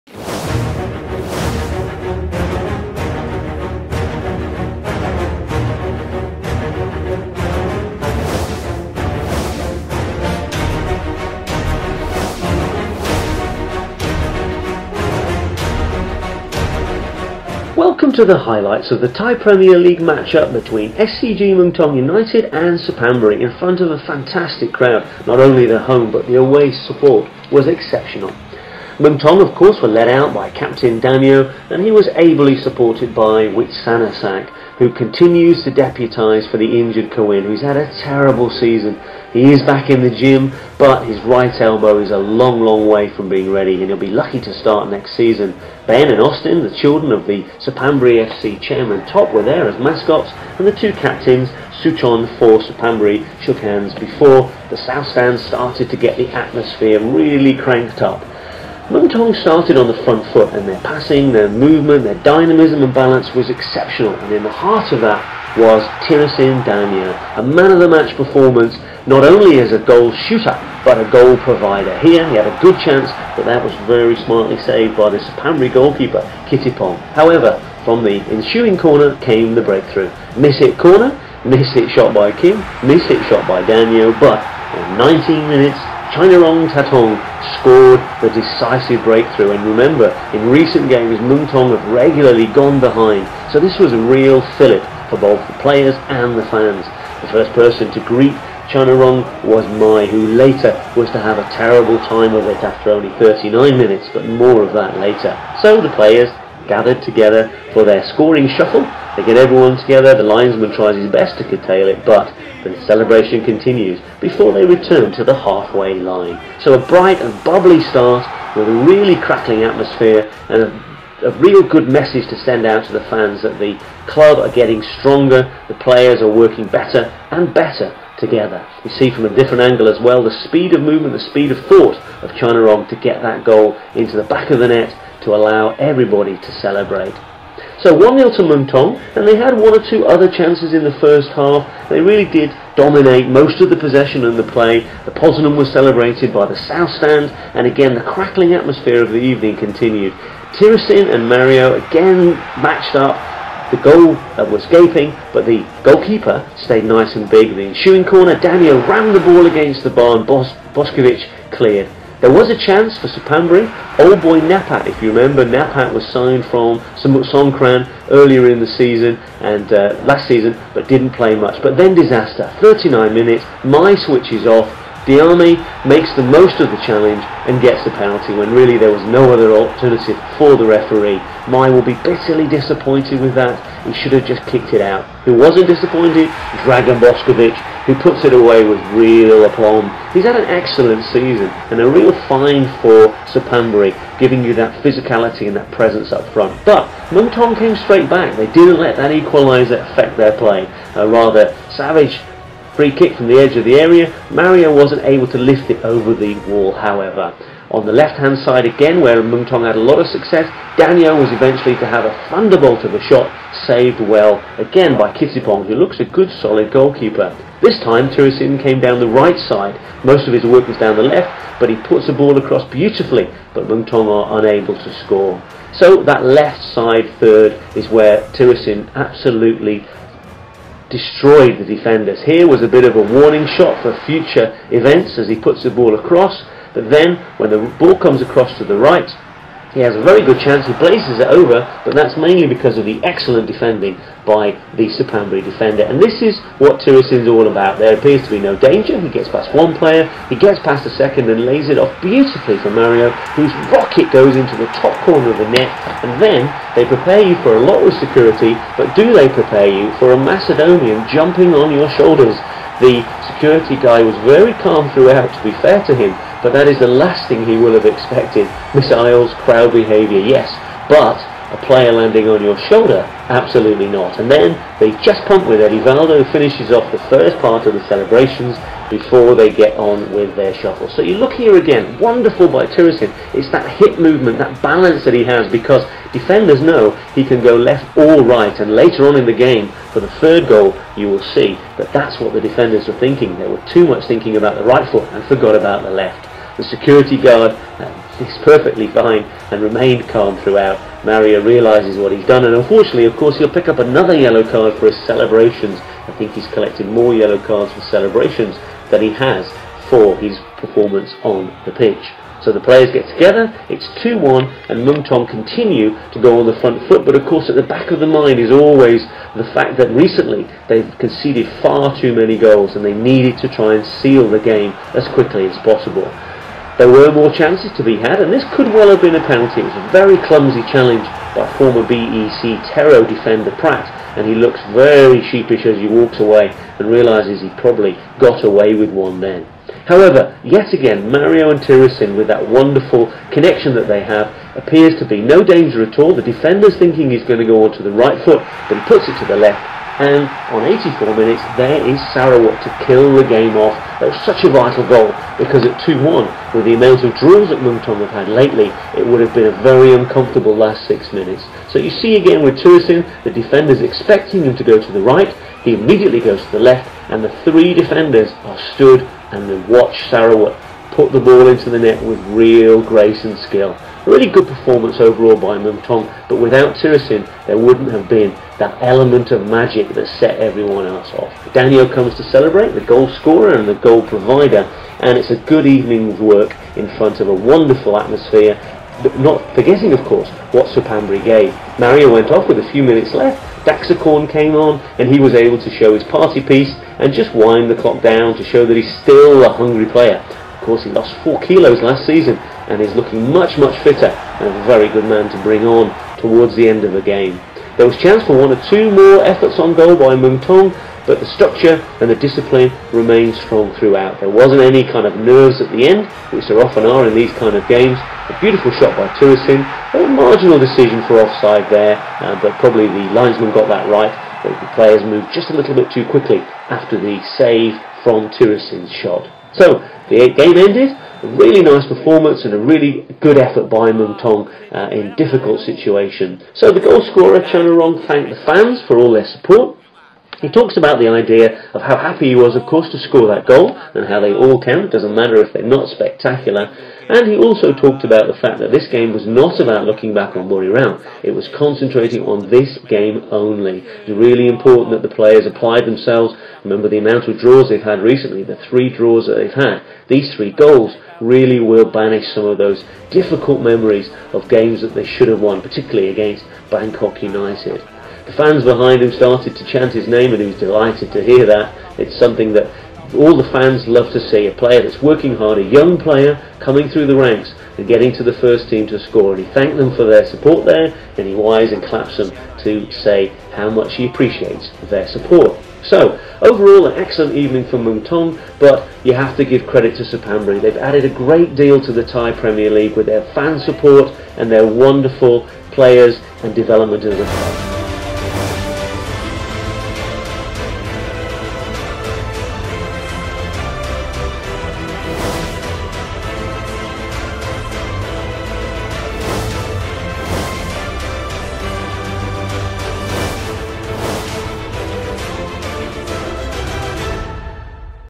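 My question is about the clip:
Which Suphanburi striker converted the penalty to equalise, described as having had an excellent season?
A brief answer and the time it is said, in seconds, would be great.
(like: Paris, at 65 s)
Dragan Boskovic, at 186 s.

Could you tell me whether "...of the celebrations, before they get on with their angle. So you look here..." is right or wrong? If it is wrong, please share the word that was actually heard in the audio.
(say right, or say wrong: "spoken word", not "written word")
wrong: "shuffle", not "angle".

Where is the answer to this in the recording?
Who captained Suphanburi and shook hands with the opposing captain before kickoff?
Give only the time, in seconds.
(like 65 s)
51 s.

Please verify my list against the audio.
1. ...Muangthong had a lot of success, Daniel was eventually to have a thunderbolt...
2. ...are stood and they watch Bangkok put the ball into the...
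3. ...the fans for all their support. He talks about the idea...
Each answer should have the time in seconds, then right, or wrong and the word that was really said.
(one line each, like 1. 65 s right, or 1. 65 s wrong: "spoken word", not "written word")
1. 209 s right
2. 368 s wrong: "Sarawut", not "Bangkok"
3. 438 s right.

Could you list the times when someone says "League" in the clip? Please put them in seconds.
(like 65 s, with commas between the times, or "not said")
19 s, 492 s.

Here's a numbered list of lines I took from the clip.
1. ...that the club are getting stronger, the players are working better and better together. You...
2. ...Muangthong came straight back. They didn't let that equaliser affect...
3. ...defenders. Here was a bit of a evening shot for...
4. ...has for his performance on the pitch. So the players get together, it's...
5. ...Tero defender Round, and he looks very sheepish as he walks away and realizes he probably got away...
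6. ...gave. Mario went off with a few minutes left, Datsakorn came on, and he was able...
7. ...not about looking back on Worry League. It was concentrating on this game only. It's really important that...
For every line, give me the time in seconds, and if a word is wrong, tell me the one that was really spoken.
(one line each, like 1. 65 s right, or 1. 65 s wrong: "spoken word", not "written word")
1. 123 s right
2. 197 s right
3. 231 s wrong: "warning", not "evening"
4. 309 s right
5. 332 s wrong: "Pratt", not "Round"
6. 391 s right
7. 449 s wrong: "Round", not "League".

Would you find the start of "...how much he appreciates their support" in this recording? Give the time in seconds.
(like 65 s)
483 s.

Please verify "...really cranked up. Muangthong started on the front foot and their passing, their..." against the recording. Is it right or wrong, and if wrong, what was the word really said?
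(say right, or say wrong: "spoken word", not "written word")
right.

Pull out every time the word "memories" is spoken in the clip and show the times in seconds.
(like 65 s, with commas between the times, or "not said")
463 s.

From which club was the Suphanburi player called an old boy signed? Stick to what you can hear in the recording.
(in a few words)
Songkran.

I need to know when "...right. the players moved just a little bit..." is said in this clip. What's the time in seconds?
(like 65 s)
423 s.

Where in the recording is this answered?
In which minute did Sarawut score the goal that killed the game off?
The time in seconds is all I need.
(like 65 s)
350 s.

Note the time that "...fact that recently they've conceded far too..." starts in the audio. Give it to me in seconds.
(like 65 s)
319 s.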